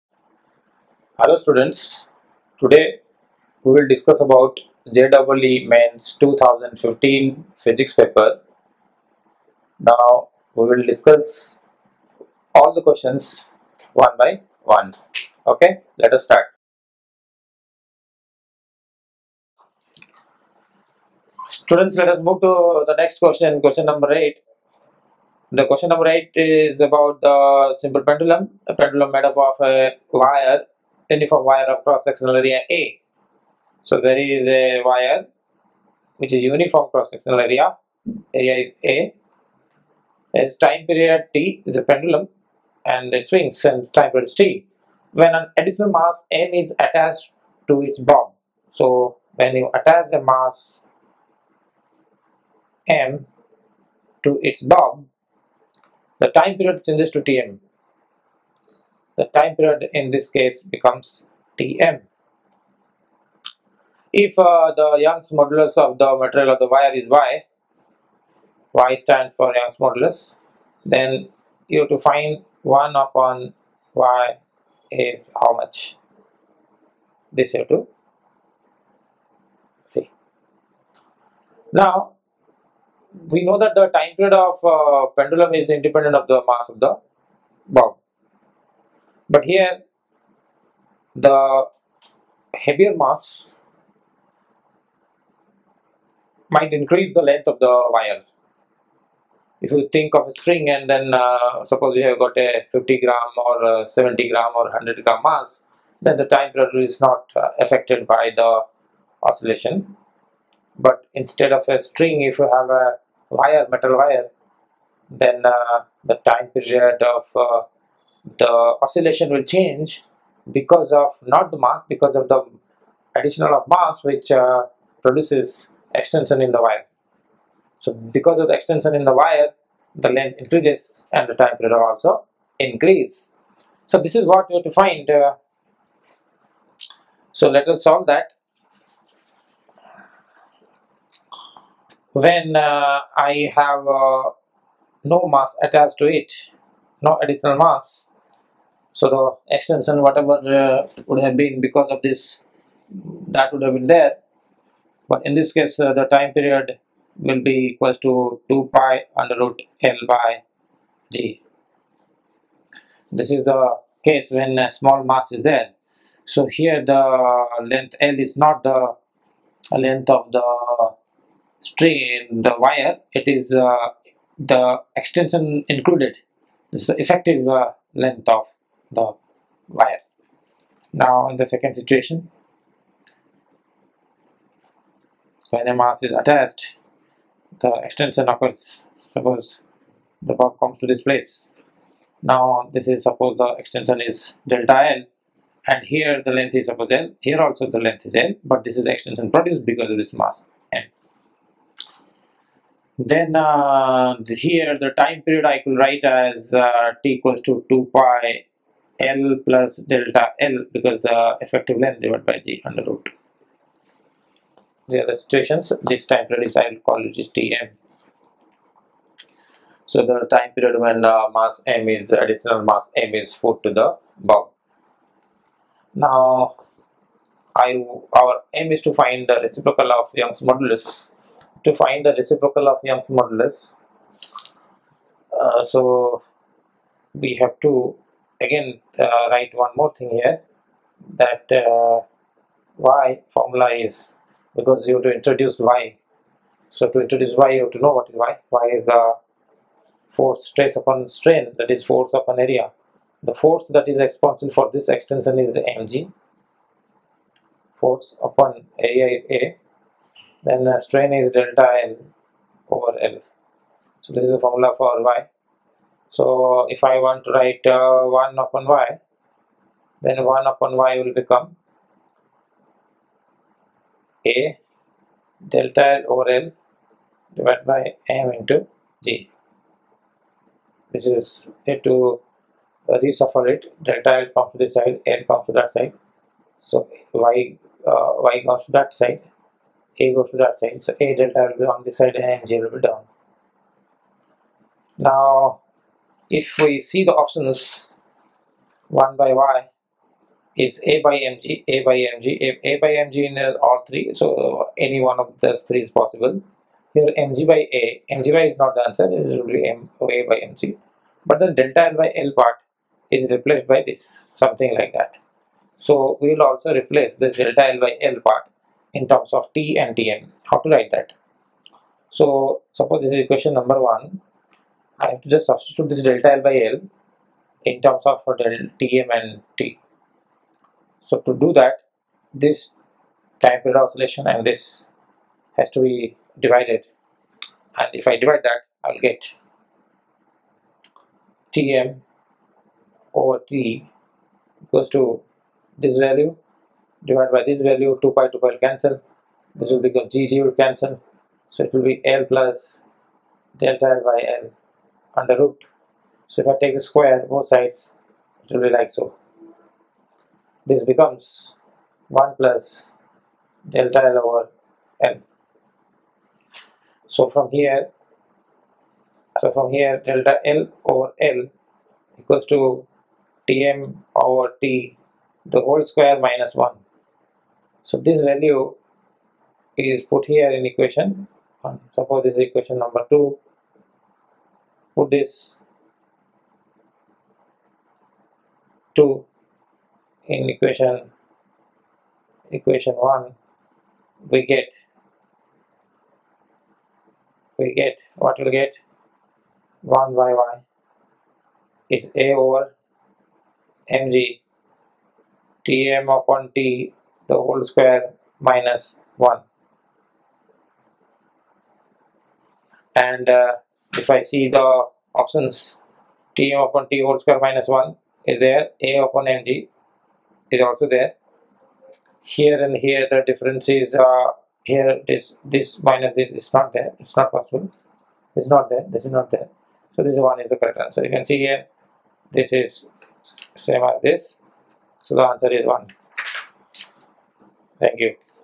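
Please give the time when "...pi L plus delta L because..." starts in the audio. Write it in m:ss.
3:27.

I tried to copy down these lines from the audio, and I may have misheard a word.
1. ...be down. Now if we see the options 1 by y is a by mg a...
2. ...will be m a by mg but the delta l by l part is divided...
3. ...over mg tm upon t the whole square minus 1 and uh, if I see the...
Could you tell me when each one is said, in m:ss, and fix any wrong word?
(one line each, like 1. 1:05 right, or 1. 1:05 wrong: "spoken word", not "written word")
1. 4:52 right
2. 5:09 wrong: "replaced", not "divided"
3. 6:42 right.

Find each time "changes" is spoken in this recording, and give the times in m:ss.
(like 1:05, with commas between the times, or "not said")
0:56, 1:59.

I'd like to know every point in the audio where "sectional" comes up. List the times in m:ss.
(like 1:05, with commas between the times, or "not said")
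0:31, 0:36.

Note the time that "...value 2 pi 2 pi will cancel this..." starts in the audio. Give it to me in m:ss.
5:47.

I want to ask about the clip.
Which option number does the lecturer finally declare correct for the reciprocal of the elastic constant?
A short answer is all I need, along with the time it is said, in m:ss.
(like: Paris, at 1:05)
1, at 7:15.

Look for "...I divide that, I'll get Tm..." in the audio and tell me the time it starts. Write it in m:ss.
5:38.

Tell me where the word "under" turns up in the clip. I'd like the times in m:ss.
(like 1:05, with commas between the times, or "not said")
2:39, 3:32, 5:55.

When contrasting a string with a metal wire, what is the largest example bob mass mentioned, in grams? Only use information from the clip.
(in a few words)
100 grams.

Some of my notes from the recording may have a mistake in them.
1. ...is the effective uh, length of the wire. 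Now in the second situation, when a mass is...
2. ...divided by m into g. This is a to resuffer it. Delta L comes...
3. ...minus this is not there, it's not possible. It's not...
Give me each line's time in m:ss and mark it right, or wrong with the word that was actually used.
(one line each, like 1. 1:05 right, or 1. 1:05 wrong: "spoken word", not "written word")
1. 2:56 right
2. 4:37 right
3. 7:05 right.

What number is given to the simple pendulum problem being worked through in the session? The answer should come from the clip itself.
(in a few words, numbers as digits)
8.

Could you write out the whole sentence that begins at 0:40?
Its time period T is a pendulum and it swings and time period is T.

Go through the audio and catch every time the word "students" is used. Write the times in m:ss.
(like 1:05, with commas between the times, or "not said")
0:01, 0:21.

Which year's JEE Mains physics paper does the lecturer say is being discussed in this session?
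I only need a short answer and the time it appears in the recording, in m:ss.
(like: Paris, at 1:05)
2015, at 0:06.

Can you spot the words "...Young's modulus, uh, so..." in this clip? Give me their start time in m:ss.
3:52.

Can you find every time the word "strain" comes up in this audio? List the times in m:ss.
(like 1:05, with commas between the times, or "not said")
4:11, 4:20.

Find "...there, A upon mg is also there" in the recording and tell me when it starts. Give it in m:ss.
6:58.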